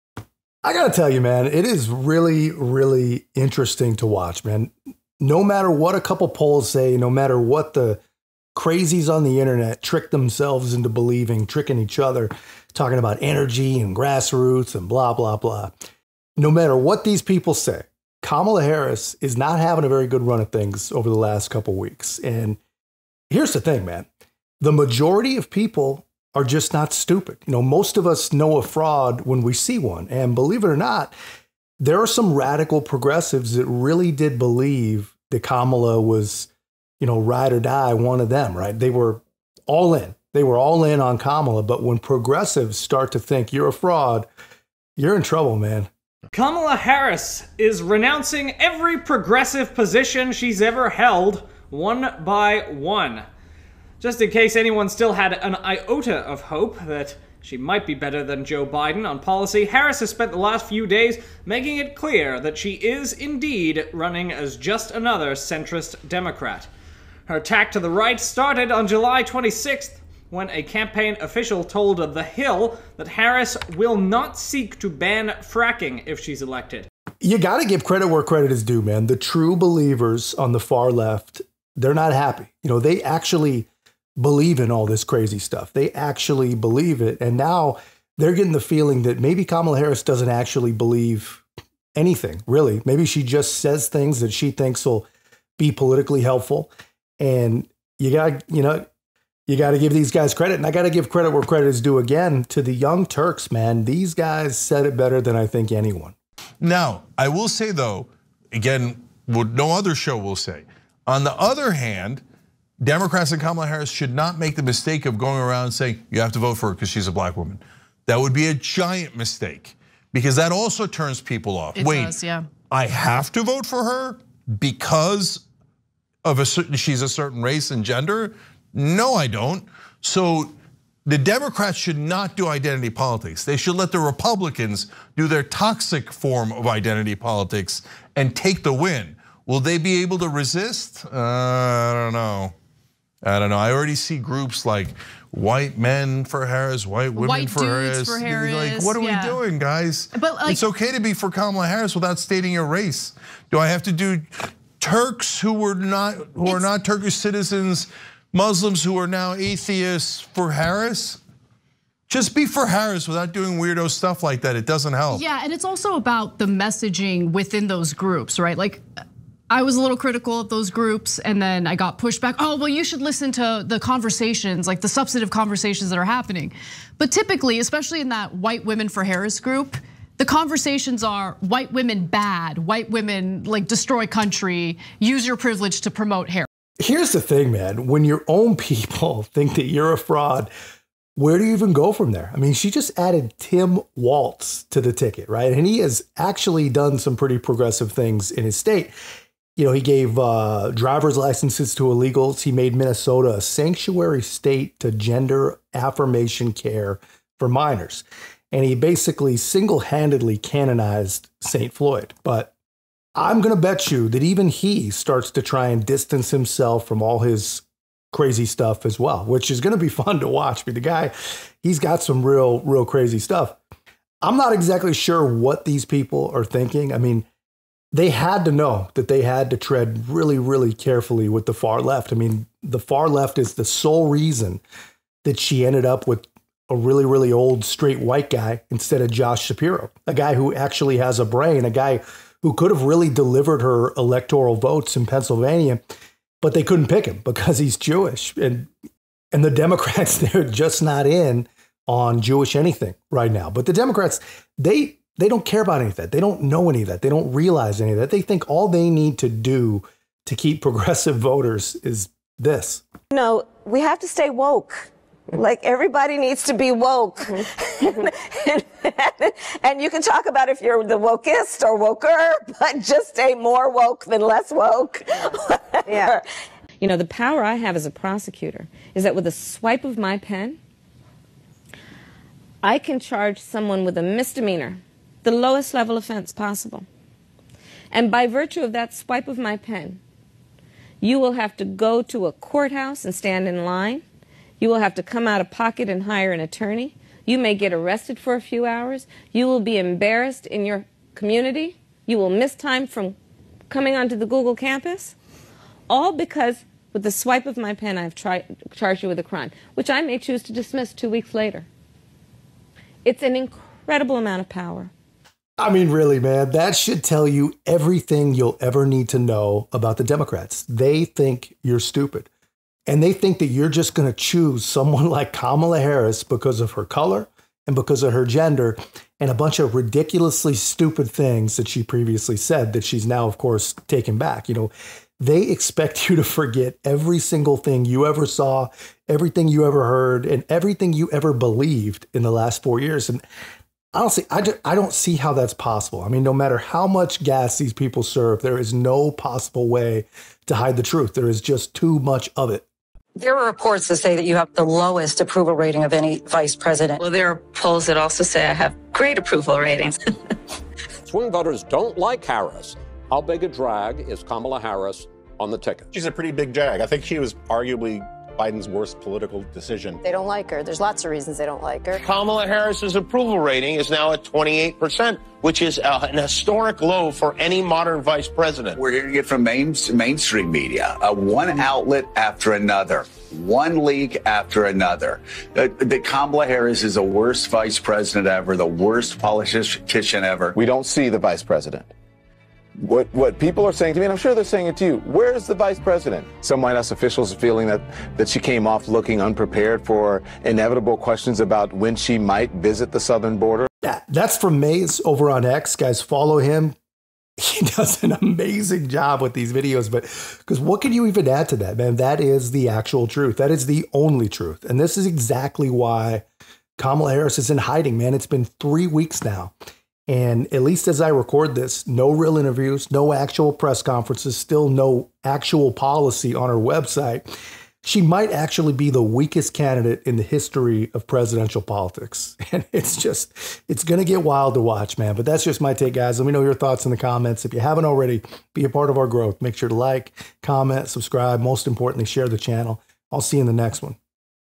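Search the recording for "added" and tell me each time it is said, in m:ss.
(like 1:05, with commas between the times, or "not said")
3:12.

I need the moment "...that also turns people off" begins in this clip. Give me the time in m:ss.
2:00.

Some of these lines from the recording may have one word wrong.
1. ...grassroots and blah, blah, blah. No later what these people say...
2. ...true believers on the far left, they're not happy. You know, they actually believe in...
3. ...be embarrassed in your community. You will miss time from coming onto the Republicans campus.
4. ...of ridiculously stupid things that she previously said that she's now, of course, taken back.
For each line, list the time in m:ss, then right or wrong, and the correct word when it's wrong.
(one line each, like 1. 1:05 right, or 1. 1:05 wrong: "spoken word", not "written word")
1. 0:13 wrong: "matter", not "later"
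2. 1:19 right
3. 4:59 wrong: "Google", not "Republicans"
4. 5:29 right.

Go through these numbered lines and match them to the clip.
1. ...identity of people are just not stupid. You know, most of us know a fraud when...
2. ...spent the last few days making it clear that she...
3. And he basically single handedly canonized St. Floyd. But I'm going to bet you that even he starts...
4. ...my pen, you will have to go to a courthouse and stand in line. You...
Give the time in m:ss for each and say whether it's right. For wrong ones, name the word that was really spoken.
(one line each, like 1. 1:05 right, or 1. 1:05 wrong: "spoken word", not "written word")
1. 0:24 wrong: "majority", not "identity"
2. 1:00 right
3. 3:28 right
4. 4:49 right.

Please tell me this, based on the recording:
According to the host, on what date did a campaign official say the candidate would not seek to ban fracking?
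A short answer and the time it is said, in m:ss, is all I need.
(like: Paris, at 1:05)
July 26th, at 1:08.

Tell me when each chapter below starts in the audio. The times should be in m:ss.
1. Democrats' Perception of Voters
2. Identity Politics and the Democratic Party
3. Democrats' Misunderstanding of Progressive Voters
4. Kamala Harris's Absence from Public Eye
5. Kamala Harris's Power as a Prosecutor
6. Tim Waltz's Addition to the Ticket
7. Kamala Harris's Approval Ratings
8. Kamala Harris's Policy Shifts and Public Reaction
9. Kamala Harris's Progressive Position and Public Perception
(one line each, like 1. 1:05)
1. 5:15
2. 1:46
3. 3:44
4. 6:54
5. 4:36
6. 3:12
7. 5:52
8. 0:46
9. 0:16.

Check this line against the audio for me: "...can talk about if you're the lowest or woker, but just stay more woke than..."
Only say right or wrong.
wrong.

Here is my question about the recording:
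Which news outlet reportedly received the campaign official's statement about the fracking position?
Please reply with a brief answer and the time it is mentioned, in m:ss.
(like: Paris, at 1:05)
The Hill, at 1:11.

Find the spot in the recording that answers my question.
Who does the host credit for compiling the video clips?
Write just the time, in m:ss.
6:44.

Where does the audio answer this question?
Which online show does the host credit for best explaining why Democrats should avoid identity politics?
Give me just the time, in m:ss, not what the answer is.
1:42.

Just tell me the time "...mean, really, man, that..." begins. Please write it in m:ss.
5:15.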